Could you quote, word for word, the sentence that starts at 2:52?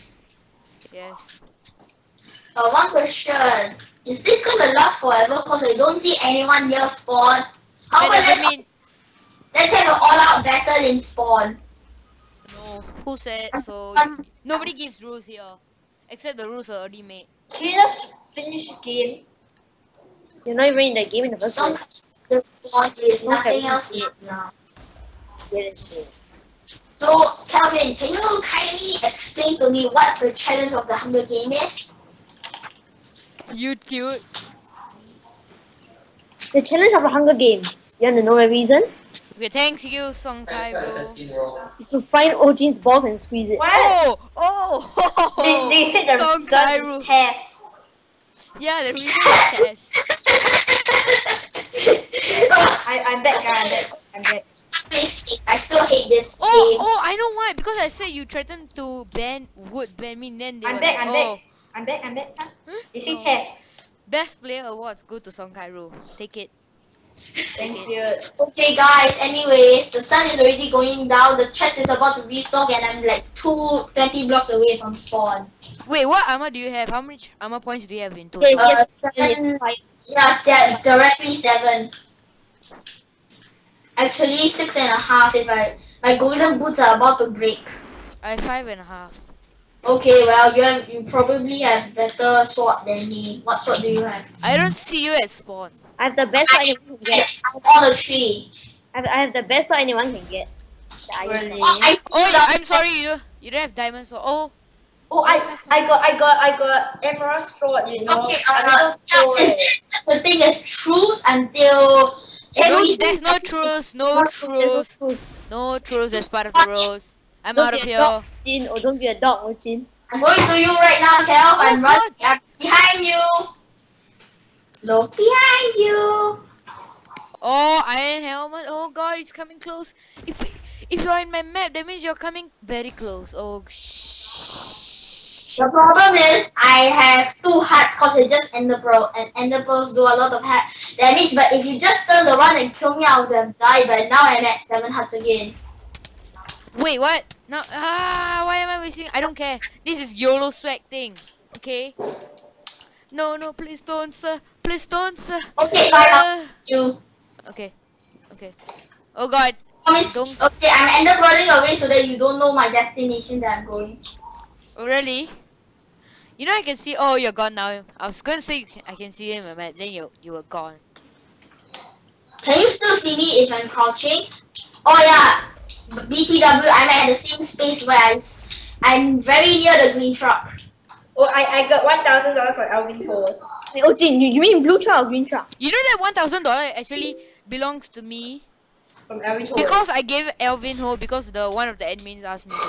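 Can you still see me if I'm crouching?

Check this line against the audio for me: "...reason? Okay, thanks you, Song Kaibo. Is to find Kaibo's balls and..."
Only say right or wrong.
wrong.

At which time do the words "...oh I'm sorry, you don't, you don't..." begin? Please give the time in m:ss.
1:42.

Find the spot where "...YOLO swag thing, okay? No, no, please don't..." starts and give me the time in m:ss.
2:30.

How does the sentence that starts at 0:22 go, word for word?
The spawn is nothing else now.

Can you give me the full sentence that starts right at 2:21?
But if you just turn around and kill me, I would have died.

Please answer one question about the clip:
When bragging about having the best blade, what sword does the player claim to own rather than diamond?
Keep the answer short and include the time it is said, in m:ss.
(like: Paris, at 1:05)
emerald sword, at 1:47.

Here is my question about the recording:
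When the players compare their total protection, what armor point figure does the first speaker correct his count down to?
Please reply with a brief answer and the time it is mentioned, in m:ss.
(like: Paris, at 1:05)
6 and a half, at 1:24.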